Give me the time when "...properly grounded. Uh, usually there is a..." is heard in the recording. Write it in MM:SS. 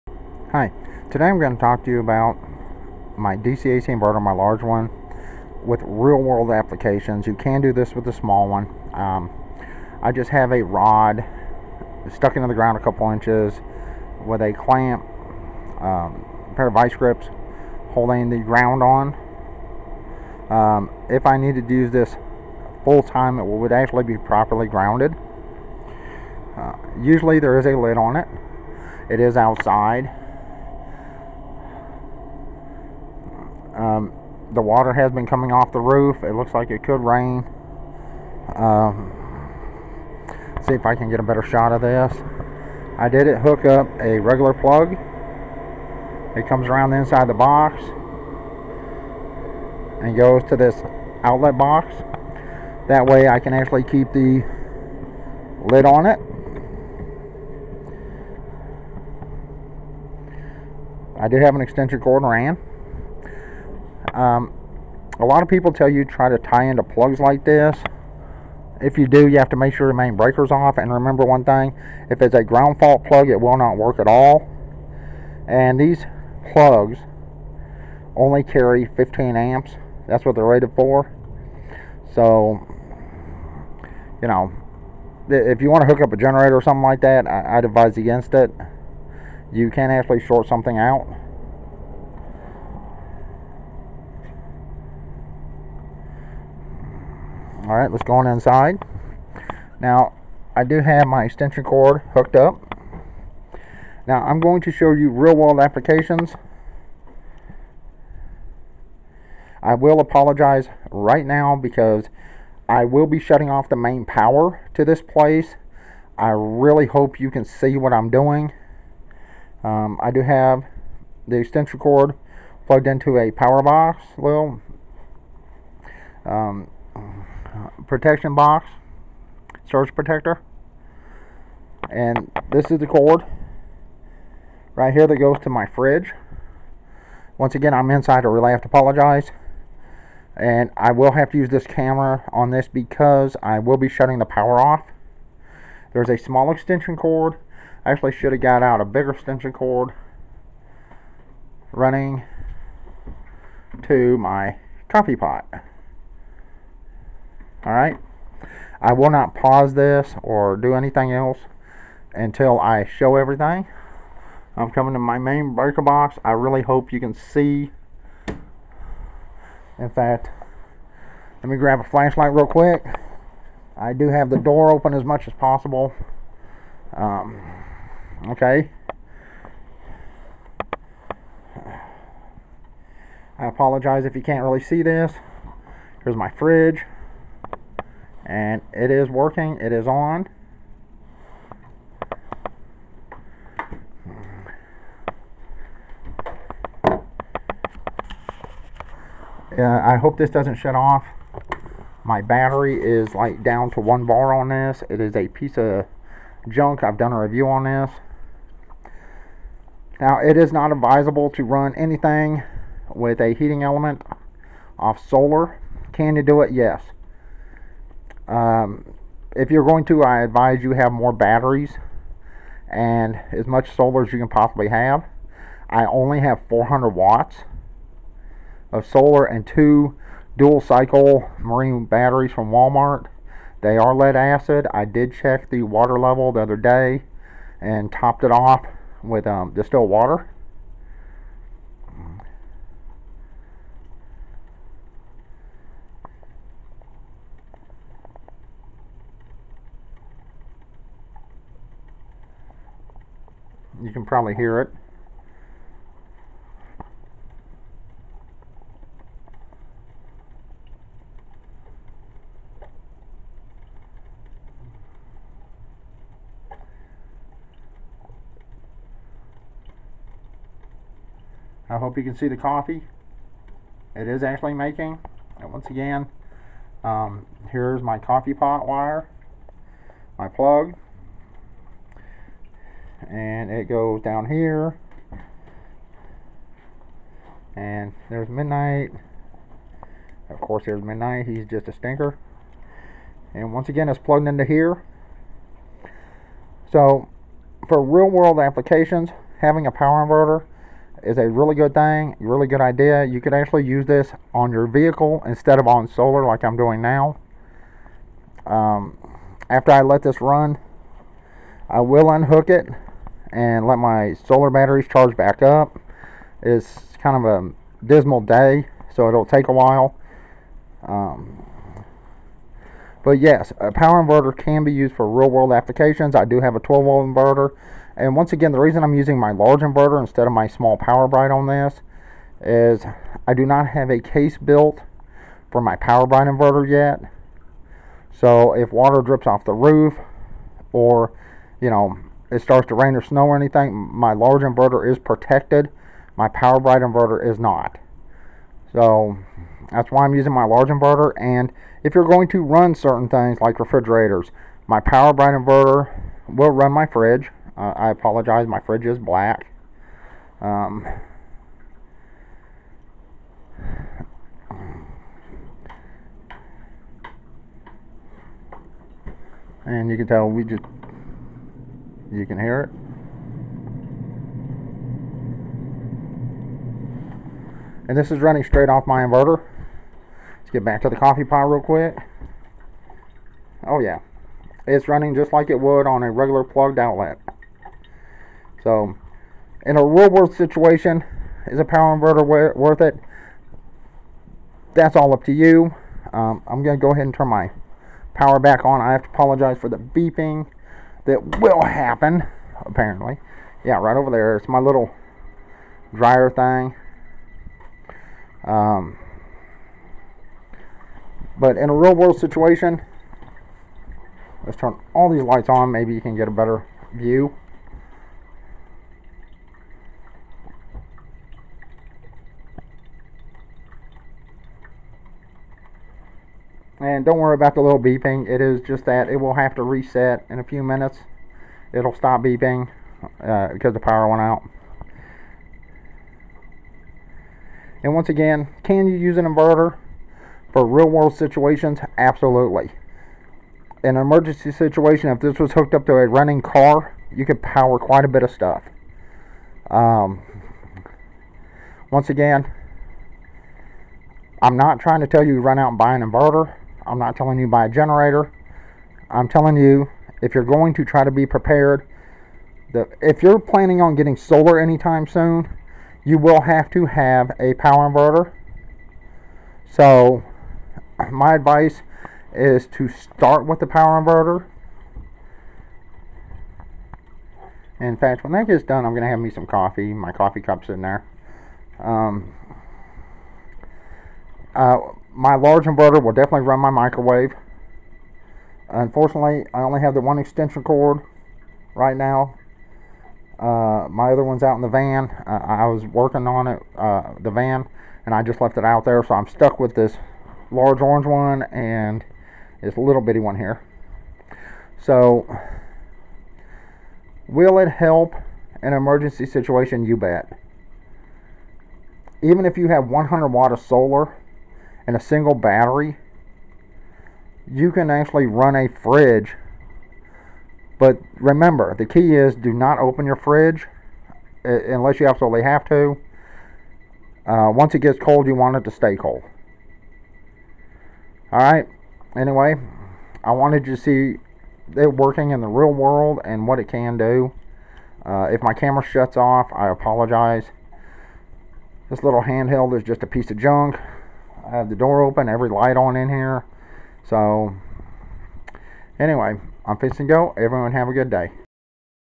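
00:24.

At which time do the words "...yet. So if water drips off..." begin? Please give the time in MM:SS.
05:36.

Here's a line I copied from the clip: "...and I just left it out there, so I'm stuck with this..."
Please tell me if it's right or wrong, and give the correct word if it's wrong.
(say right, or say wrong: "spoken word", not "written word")
right.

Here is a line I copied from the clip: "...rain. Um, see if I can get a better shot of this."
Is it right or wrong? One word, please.
right.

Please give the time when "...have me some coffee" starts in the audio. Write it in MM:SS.
07:59.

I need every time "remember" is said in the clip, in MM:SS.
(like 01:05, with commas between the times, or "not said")
01:10, 08:41.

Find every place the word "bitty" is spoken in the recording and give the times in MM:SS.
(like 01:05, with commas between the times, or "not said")
08:23.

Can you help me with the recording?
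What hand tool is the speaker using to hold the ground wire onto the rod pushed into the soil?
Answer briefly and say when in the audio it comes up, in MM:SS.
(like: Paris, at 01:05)
Vice grips, at 00:16.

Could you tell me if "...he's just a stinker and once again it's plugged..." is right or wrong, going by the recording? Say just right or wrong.
right.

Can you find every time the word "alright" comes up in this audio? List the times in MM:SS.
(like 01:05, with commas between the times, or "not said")
01:37, 02:37, 08:51.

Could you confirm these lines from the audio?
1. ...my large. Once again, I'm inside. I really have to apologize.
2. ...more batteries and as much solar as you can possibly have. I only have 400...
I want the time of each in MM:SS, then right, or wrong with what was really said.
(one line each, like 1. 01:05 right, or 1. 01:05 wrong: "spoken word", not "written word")
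1. 02:15 wrong: "fridge", not "large"
2. 03:40 right.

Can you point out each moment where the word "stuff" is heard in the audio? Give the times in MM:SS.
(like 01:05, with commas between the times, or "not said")
07:28.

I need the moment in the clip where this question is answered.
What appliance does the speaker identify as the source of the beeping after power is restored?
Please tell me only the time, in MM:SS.
06:45.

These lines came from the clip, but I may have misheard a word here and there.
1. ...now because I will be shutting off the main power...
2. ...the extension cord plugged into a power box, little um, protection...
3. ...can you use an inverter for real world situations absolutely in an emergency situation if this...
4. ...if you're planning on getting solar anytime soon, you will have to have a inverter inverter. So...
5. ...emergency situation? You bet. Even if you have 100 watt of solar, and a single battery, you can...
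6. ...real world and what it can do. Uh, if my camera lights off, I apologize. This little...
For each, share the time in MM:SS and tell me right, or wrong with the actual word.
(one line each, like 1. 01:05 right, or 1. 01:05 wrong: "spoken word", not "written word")
1. 01:51 right
2. 02:01 right
3. 07:18 right
4. 07:43 wrong: "power", not "inverter"
5. 08:28 right
6. 08:55 wrong: "shuts", not "lights".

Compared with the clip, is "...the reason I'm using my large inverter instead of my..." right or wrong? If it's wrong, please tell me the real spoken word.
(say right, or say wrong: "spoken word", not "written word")
right.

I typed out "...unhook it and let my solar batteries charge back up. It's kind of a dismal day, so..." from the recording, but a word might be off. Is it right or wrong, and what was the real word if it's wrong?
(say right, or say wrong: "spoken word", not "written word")
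right.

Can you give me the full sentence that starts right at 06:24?
It's running just like it would on a regular plugged outlet.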